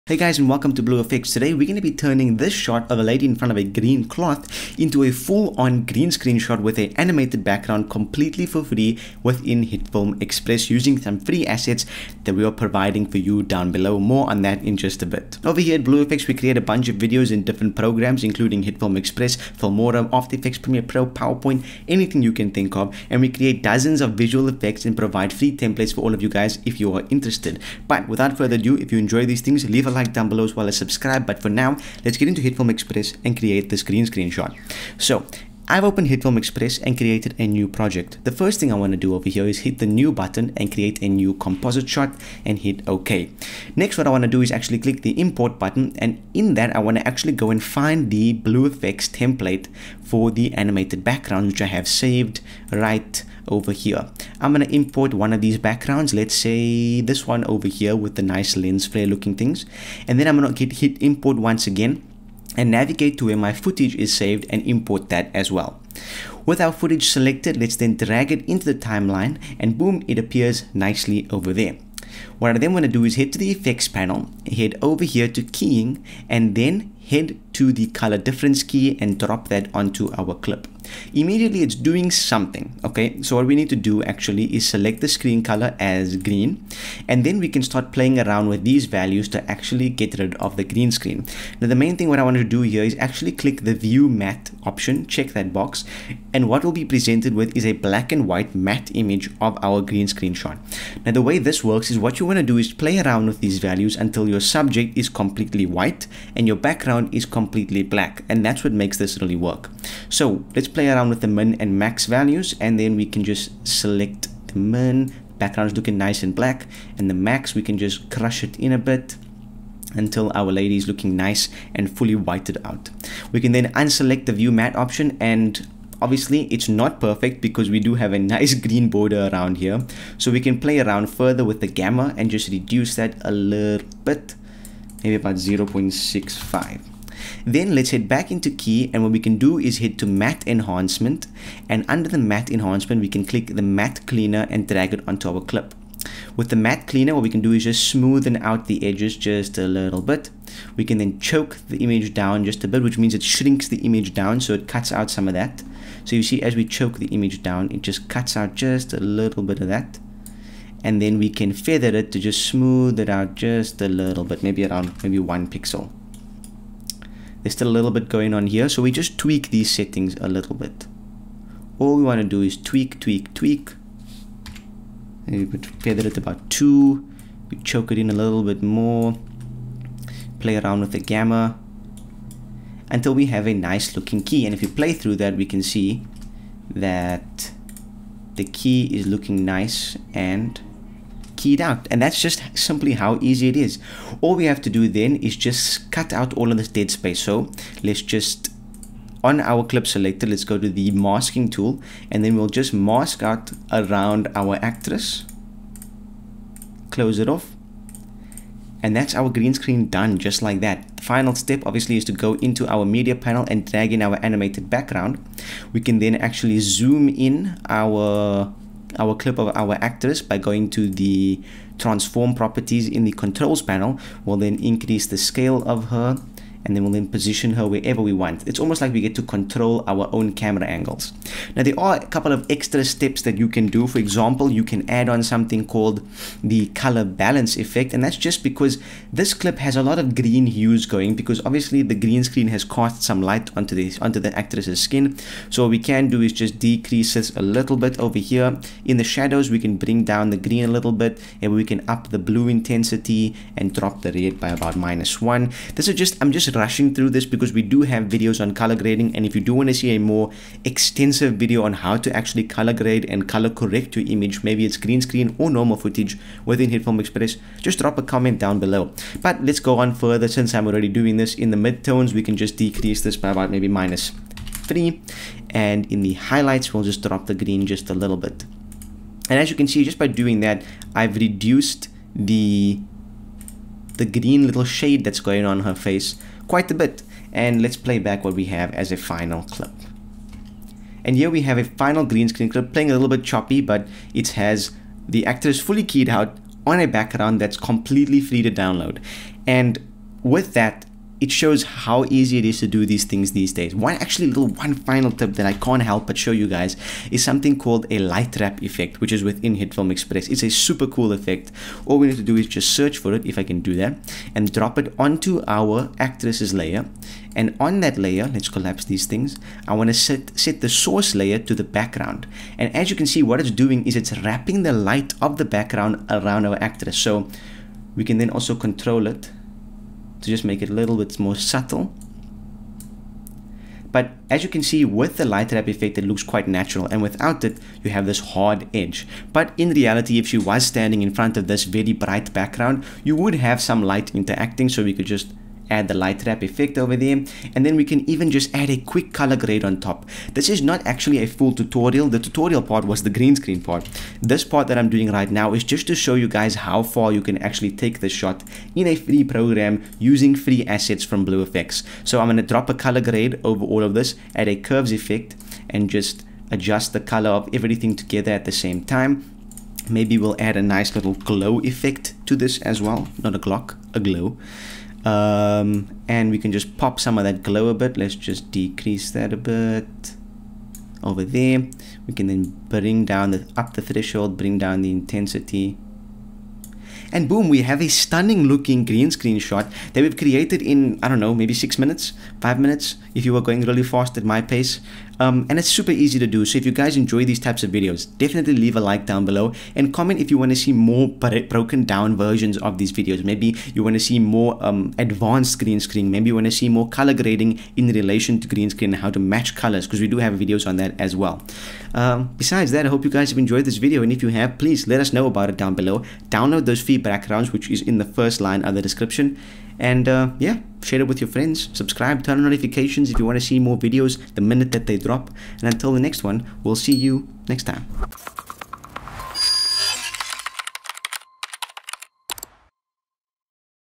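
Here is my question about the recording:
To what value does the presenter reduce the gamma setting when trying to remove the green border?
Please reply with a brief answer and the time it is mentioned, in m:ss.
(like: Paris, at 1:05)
0.65, at 2:15.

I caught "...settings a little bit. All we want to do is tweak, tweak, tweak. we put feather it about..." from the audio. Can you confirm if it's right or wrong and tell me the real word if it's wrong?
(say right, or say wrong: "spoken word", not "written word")
right.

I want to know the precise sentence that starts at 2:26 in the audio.
With the matte cleaner, what we can do is just smoothen out the edges just a little bit.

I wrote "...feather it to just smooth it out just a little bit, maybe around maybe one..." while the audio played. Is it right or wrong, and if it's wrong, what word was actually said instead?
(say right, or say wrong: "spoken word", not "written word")
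right.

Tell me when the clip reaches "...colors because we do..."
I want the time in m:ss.
6:49.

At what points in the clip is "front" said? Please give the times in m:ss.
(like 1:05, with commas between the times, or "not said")
0:03, 5:41.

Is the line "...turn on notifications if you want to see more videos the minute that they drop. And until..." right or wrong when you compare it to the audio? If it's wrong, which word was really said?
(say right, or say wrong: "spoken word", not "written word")
right.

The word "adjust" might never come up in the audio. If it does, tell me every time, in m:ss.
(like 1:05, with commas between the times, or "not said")
6:06.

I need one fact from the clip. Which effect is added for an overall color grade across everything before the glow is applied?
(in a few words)
Curves.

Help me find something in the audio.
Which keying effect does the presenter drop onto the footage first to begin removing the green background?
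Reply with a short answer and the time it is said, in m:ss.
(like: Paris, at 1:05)
Color difference key, at 1:17.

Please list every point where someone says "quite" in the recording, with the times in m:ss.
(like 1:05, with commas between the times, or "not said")
4:46, 5:36.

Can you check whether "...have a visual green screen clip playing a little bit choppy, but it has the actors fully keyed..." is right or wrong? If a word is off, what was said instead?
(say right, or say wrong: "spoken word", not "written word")
wrong: "final", not "visual".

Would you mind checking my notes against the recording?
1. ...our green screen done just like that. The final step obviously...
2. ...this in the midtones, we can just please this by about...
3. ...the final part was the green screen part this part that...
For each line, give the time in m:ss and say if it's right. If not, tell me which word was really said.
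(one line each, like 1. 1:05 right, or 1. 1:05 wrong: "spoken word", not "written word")
1. 3:29 right
2. 4:31 wrong: "decrease", not "please"
3. 5:52 wrong: "tutorial", not "final".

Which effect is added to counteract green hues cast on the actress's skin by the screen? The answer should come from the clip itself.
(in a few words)
Color balance.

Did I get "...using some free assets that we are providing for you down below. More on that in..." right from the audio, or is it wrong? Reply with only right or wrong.
right.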